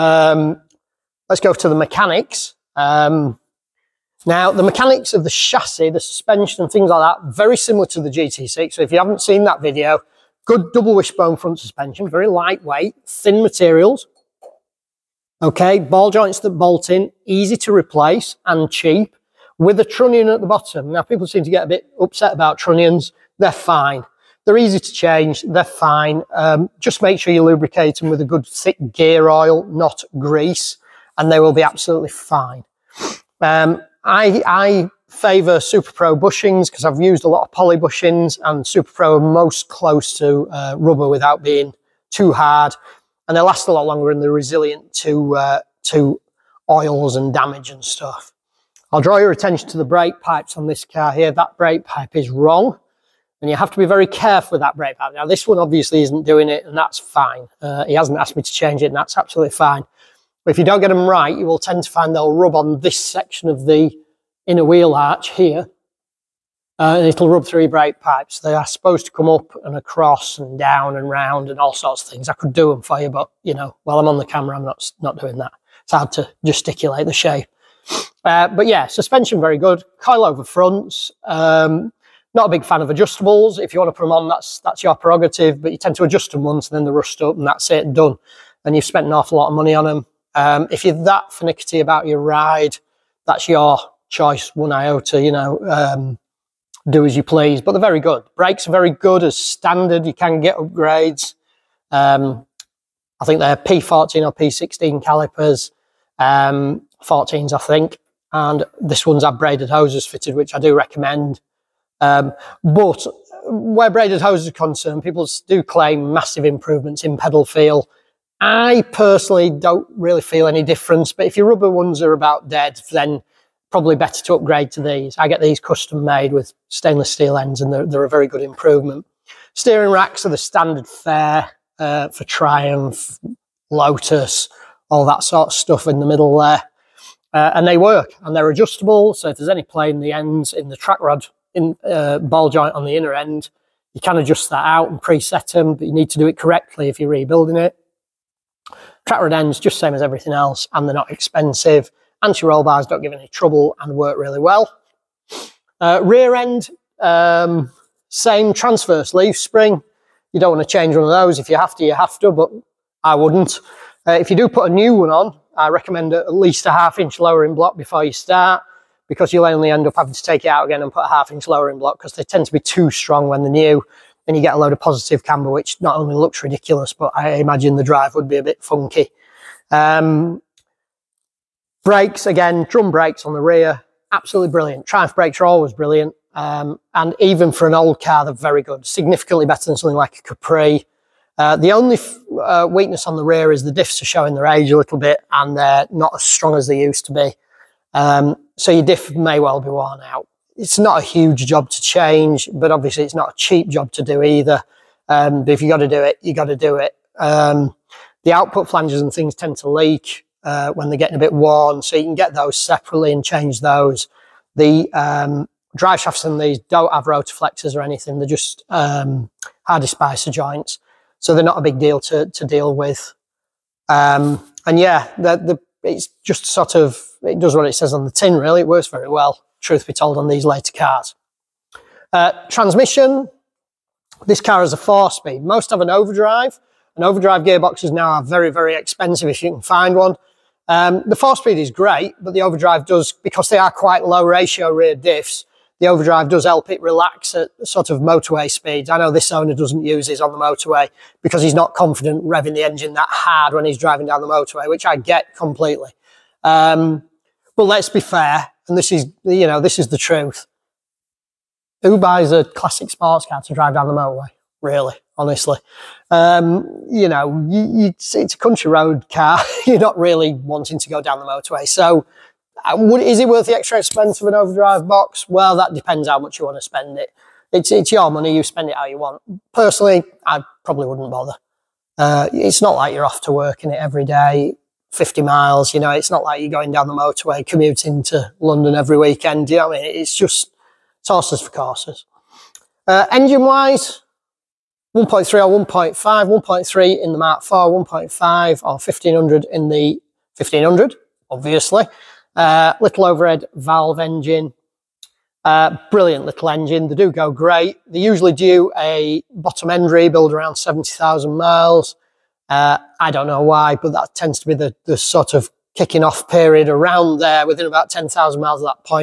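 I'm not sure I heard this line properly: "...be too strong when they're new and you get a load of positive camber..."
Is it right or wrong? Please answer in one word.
right.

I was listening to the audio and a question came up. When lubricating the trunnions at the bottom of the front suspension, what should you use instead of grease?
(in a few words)
thick gear oil.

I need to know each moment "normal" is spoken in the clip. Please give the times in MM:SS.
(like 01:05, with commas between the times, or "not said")
not said.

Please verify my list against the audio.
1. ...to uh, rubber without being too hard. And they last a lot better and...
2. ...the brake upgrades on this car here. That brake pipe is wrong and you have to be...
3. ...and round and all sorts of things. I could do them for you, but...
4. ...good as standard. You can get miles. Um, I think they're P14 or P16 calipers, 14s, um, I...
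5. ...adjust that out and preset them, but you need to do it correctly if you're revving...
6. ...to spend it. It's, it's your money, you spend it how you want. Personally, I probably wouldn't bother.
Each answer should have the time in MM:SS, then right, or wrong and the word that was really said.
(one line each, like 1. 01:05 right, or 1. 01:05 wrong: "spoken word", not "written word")
1. 00:40 wrong: "longer", not "better"
2. 00:49 wrong: "pipes", not "upgrades"
3. 01:10 right
4. 01:38 wrong: "upgrades", not "miles"
5. 02:24 wrong: "rebuilding", not "revving"
6. 04:36 right.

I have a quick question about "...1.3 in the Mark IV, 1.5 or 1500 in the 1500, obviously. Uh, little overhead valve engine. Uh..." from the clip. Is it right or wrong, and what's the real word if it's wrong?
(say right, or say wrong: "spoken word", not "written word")
right.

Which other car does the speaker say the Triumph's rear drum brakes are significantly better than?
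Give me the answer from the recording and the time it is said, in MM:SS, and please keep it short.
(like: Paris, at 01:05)
Capri, at 03:10.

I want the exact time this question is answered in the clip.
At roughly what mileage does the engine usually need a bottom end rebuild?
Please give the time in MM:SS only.
05:10.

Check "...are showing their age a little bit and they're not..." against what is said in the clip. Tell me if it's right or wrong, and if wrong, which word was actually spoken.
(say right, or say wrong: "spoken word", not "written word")
right.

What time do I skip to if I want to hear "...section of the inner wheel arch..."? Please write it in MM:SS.
01:02.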